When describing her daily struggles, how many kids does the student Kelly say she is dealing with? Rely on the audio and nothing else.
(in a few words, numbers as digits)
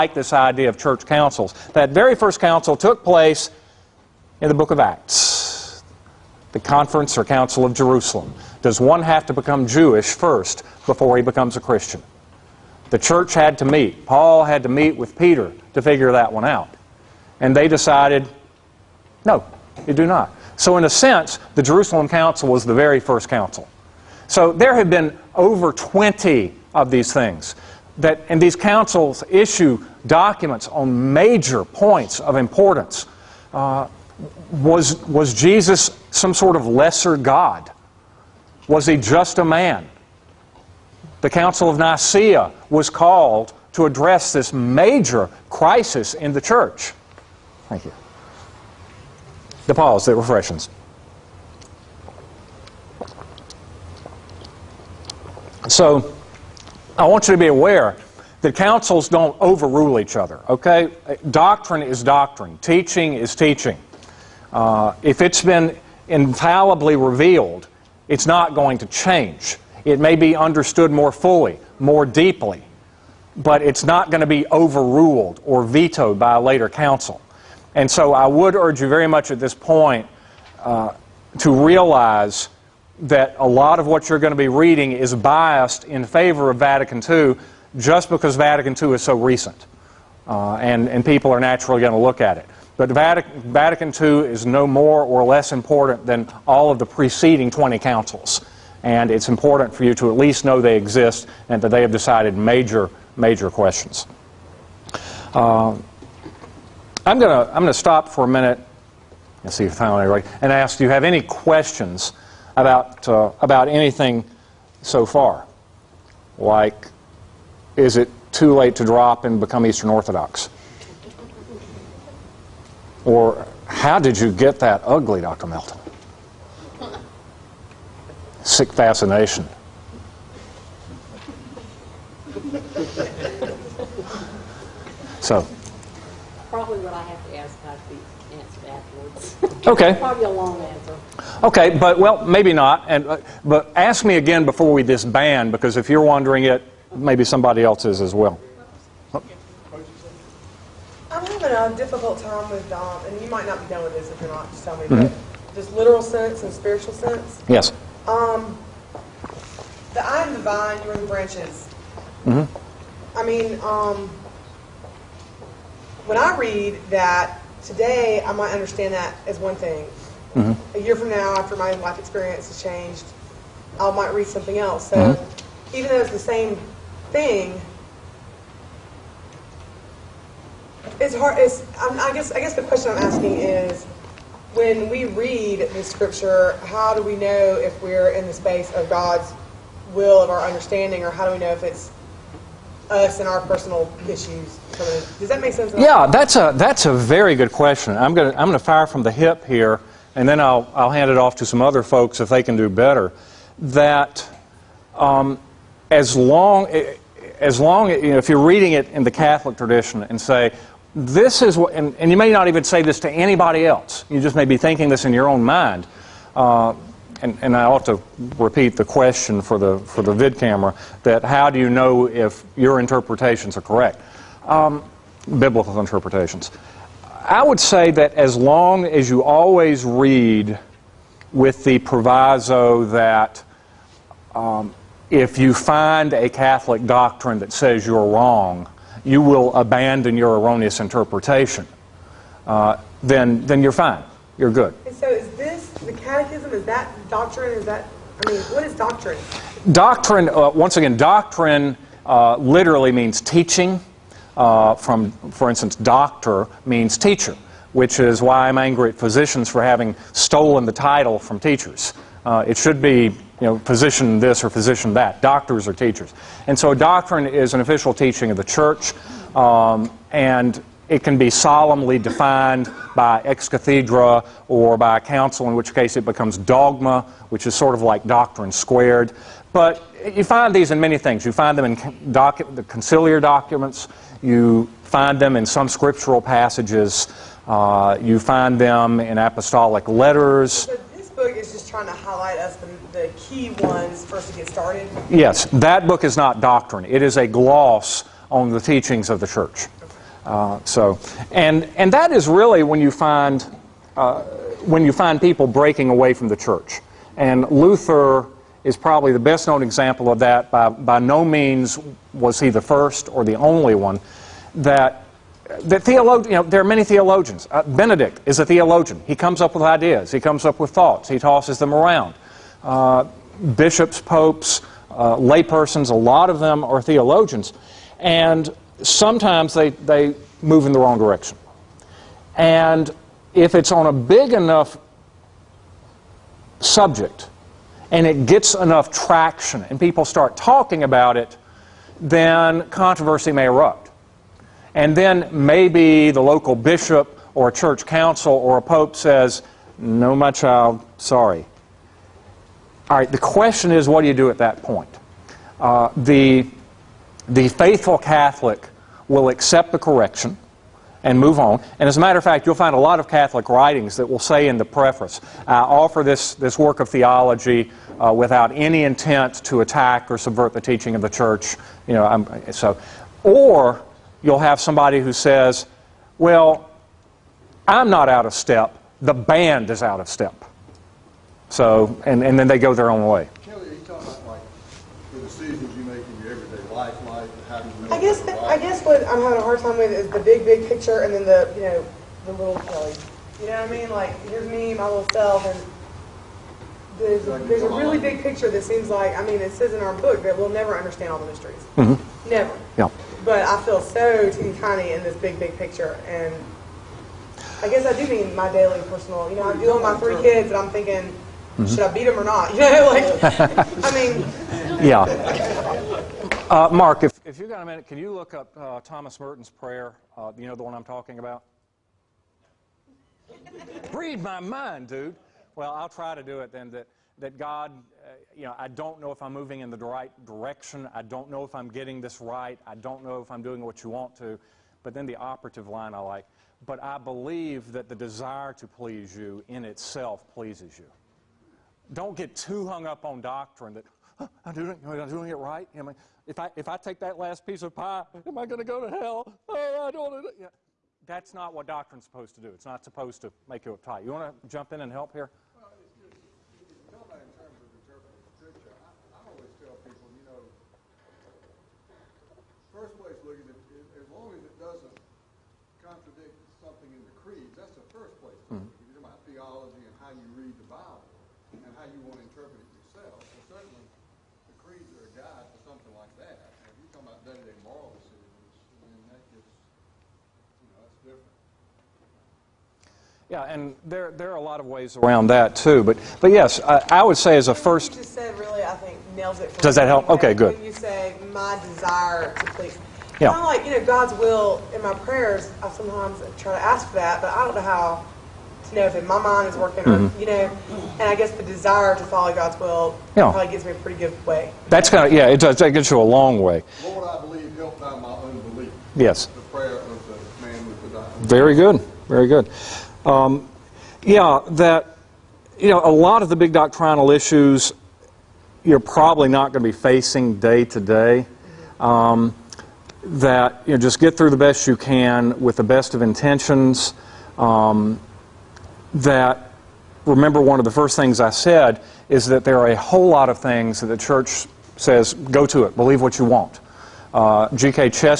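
3.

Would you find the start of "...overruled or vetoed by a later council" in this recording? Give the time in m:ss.
1:14.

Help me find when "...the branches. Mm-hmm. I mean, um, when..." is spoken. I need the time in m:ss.
2:40.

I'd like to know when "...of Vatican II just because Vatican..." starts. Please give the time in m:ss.
1:26.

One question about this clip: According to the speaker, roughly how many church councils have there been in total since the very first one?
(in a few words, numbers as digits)
over 20.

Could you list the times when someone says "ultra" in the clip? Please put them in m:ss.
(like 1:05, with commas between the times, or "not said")
not said.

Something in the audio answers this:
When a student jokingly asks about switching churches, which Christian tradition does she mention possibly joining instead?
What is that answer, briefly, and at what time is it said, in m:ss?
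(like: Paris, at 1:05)
Eastern Orthodox, at 1:59.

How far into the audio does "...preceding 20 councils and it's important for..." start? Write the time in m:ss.
1:36.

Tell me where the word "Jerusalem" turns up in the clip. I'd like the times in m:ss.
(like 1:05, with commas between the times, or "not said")
0:07, 0:21.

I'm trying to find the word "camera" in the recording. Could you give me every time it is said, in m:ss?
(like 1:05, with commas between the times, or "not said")
3:40.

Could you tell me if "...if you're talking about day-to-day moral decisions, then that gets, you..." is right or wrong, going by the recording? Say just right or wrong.
right.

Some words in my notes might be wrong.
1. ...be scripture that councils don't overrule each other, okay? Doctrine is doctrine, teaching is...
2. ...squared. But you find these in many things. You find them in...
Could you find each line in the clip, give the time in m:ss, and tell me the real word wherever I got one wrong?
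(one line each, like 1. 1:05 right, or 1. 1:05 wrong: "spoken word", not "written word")
1. 0:57 wrong: "aware", not "scripture"
2. 4:38 right.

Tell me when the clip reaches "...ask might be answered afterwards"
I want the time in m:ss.
2:17.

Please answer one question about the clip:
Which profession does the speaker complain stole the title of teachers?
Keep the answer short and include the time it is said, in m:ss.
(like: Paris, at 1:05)
physicians, at 4:18.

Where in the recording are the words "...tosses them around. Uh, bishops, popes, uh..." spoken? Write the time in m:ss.
5:21.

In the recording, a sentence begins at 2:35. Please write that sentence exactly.
but just literal sense and spiritual sense.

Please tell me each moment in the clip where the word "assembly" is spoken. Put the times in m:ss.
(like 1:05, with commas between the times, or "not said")
not said.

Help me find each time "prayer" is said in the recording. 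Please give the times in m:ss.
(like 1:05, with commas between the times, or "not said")
6:59, 8:14, 8:29.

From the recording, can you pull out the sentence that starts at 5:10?
By by no means was he the first or the only one that the you know, there are many theologians.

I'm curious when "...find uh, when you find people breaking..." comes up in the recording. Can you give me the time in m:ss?
5:02.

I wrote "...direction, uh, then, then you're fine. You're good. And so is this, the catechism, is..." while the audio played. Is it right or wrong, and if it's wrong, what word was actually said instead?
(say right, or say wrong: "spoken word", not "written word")
wrong: "interpretation", not "direction".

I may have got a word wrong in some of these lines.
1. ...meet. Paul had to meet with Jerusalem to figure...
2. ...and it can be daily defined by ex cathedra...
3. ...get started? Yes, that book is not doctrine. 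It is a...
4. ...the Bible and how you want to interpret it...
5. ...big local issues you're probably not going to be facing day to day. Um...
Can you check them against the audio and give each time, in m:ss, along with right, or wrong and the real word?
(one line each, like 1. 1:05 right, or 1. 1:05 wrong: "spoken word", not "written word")
1. 0:13 wrong: "Peter", not "Jerusalem"
2. 4:30 wrong: "solemnly", not "daily"
3. 4:54 right
4. 7:50 right
5. 8:36 wrong: "doctrinal", not "local".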